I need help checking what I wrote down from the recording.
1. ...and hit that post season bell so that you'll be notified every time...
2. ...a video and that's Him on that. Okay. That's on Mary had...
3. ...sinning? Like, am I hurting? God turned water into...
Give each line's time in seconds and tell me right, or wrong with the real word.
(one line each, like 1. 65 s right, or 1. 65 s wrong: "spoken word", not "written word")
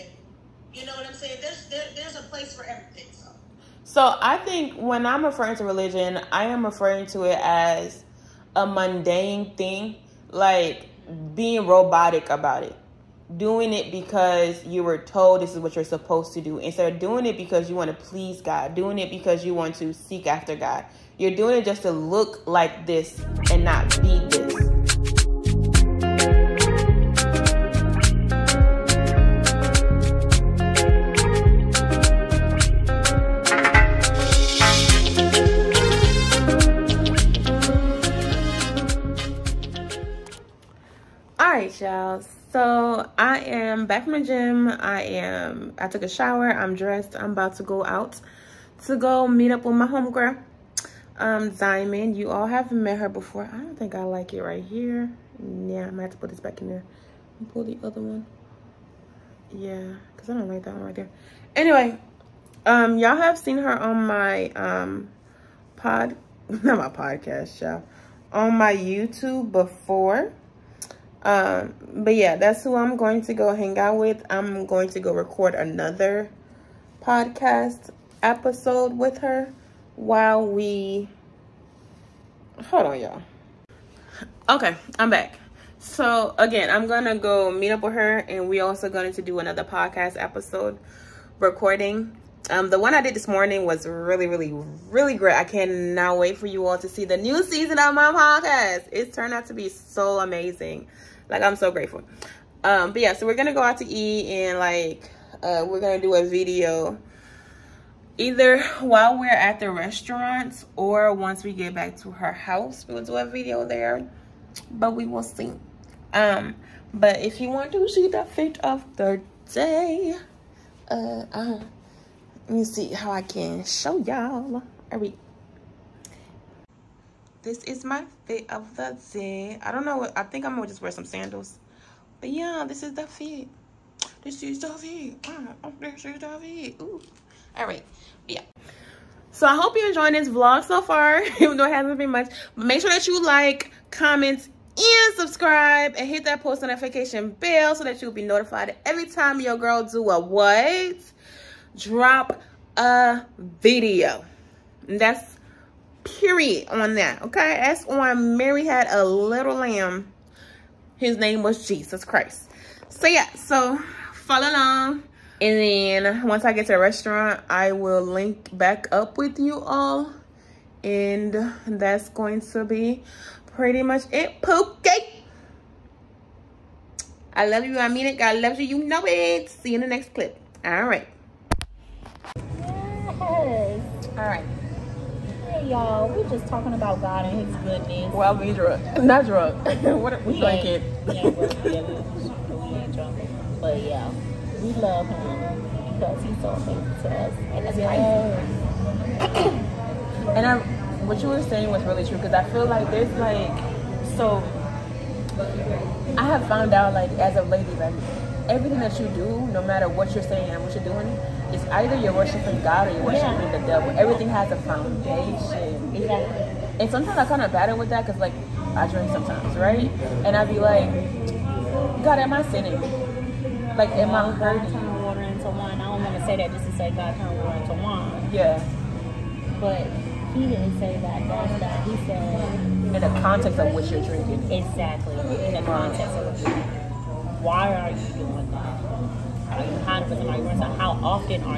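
1. 145 s wrong: "notification", not "season"
2. 152 s wrong: "Period", not "Him"
3. 222 s right.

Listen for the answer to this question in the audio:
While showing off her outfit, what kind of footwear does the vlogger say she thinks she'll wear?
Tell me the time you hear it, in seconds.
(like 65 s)
131 s.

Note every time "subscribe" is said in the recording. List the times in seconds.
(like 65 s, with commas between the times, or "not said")
145 s.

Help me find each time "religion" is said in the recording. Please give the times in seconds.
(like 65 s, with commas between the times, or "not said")
5 s.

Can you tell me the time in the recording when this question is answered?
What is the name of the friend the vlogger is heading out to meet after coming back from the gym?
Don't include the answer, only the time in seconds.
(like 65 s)
51 s.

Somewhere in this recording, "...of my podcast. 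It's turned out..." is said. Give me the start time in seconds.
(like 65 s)
97 s.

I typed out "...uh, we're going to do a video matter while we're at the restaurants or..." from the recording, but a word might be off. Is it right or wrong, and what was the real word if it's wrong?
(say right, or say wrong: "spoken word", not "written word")
wrong: "either", not "matter".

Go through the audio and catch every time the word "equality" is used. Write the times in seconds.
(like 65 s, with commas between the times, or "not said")
not said.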